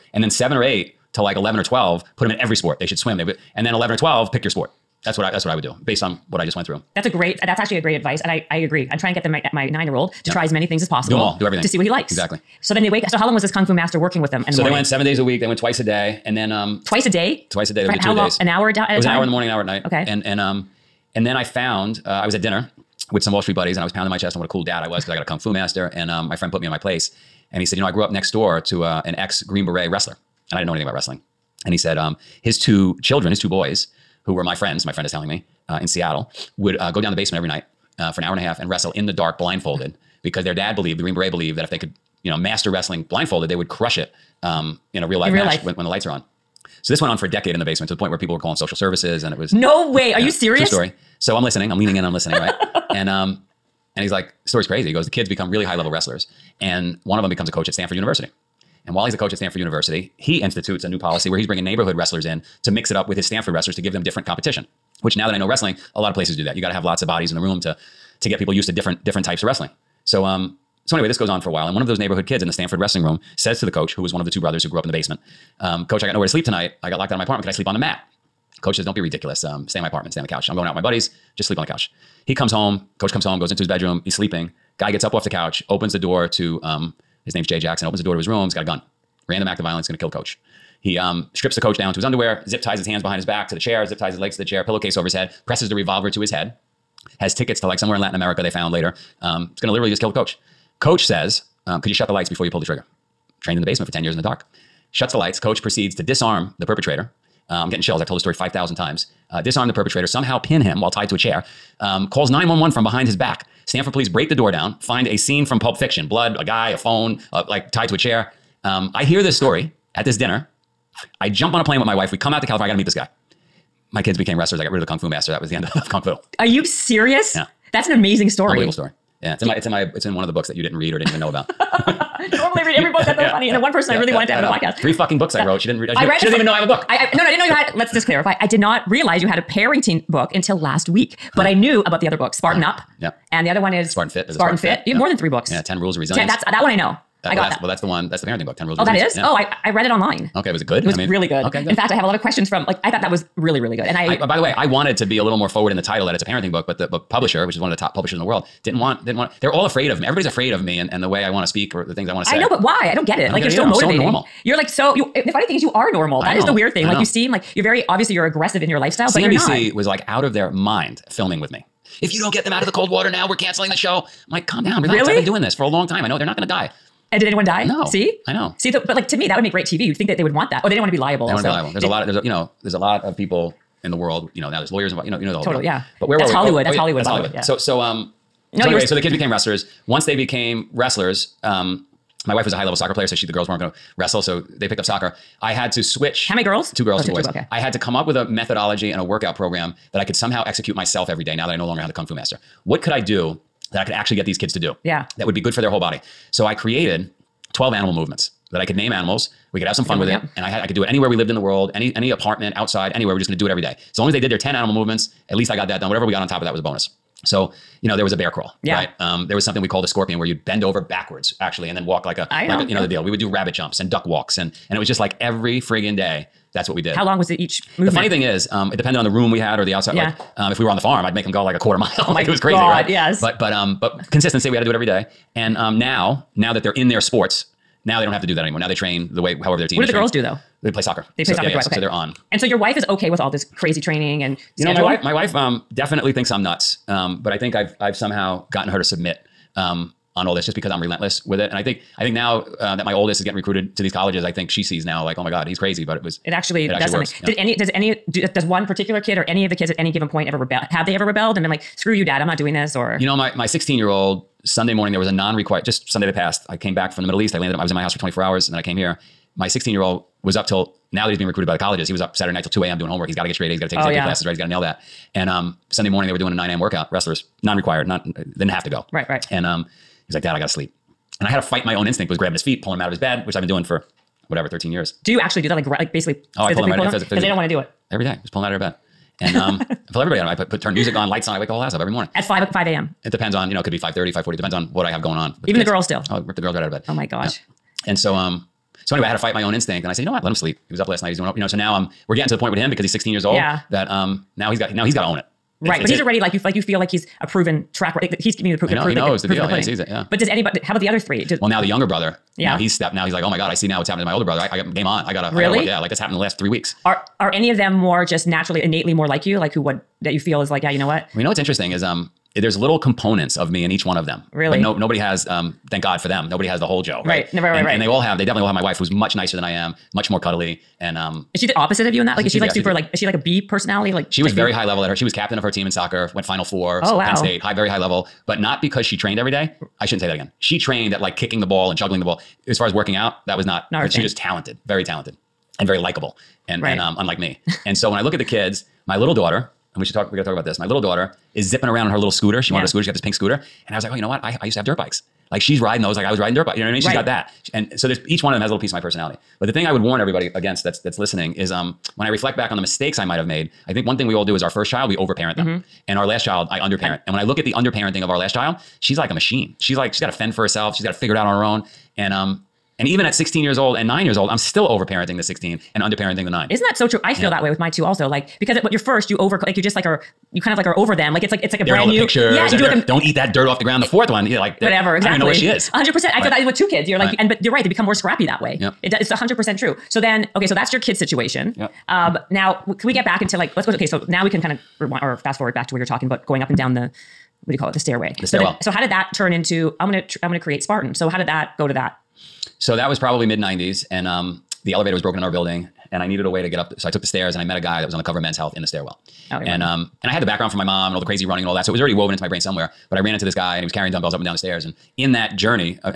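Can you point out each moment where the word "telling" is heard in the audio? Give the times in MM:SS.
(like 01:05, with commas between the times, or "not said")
00:35.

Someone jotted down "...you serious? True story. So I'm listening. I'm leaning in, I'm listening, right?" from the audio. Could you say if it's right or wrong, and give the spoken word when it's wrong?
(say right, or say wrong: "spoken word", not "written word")
right.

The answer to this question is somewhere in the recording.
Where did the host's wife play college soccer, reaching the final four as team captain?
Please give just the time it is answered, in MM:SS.
05:37.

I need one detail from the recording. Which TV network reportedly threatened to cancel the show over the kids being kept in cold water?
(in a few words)
CNBC.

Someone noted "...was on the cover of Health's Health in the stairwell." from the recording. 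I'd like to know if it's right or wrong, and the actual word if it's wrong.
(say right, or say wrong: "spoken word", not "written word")
wrong: "Men", not "Health".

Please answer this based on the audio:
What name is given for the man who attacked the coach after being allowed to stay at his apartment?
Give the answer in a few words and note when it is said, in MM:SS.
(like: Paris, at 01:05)
Jay Jackson, at 01:27.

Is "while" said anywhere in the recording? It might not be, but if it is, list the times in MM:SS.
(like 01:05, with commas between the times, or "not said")
00:58, 01:11, 01:50.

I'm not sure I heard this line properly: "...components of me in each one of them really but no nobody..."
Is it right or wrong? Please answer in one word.
right.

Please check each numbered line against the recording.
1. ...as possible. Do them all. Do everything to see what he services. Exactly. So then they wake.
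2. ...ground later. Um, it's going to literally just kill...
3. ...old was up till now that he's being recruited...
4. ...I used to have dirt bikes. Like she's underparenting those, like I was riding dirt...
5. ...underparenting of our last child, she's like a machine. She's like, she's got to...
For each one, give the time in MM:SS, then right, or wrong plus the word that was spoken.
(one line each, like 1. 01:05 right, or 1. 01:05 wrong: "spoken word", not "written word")
1. 00:10 wrong: "likes", not "services"
2. 01:38 wrong: "found", not "ground"
3. 04:29 right
4. 05:54 wrong: "riding", not "underparenting"
5. 06:07 right.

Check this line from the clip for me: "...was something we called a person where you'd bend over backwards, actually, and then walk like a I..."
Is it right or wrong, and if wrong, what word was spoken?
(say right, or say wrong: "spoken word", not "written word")
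wrong: "scorpion", not "person".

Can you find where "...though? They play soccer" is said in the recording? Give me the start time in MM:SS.
04:00.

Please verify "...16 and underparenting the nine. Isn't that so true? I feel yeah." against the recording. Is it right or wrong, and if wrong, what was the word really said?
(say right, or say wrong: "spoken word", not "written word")
right.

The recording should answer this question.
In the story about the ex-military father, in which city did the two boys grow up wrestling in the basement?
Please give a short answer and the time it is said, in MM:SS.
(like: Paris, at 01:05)
Seattle, at 00:35.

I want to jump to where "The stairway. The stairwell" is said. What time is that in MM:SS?
06:37.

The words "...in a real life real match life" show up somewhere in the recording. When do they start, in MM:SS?
00:44.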